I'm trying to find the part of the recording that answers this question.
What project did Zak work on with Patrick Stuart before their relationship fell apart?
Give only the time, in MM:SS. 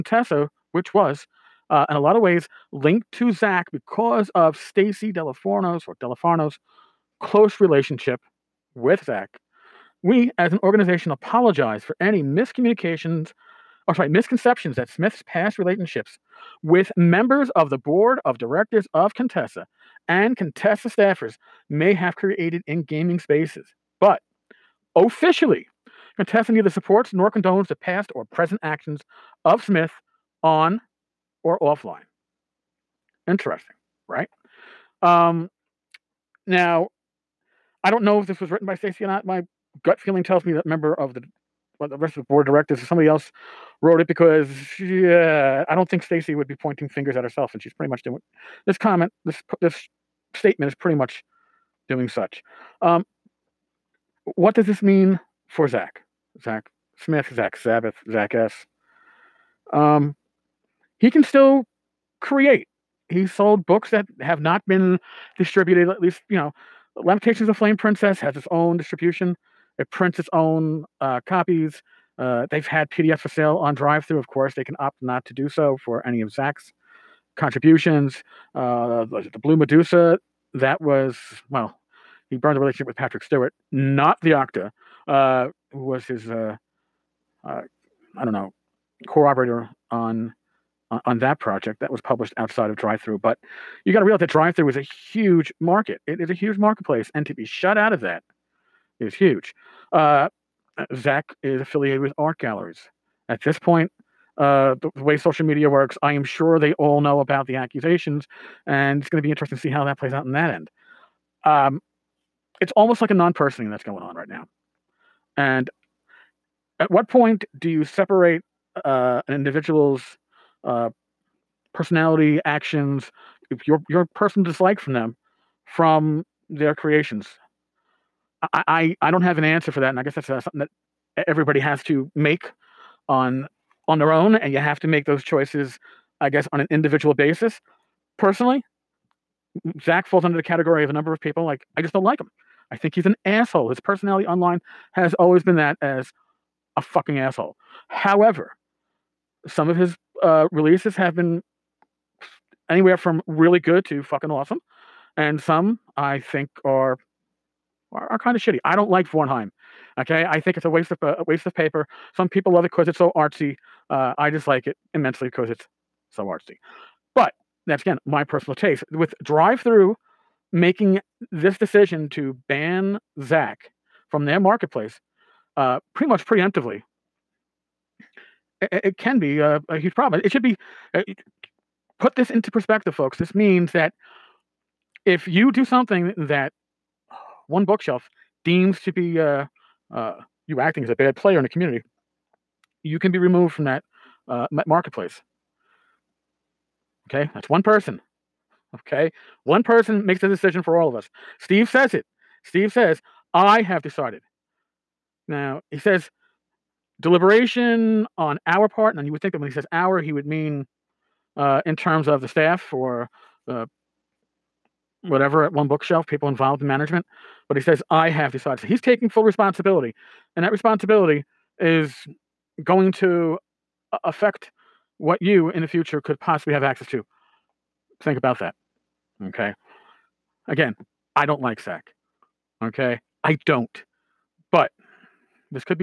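01:19.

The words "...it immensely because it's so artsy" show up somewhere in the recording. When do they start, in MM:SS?
02:44.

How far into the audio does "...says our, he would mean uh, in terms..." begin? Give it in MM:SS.
03:29.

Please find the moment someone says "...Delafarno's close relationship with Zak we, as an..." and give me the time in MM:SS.
00:06.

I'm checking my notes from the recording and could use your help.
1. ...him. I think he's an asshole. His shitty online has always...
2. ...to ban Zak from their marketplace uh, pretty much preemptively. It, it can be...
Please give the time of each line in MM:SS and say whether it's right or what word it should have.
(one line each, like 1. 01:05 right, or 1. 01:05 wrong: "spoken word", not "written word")
1. 02:22 wrong: "personality", not "shitty"
2. 02:52 right.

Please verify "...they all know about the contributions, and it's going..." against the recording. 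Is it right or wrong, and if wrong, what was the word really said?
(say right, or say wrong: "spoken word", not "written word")
wrong: "accusations", not "contributions".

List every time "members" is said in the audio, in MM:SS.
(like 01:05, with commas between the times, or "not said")
00:16, 00:40.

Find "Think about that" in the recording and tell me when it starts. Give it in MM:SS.
03:48.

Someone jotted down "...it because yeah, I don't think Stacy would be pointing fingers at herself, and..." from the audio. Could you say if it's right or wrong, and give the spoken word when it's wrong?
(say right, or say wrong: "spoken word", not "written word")
right.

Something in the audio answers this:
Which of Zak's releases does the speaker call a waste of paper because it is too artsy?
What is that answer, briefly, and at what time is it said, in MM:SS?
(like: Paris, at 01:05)
Vornheim, at 02:39.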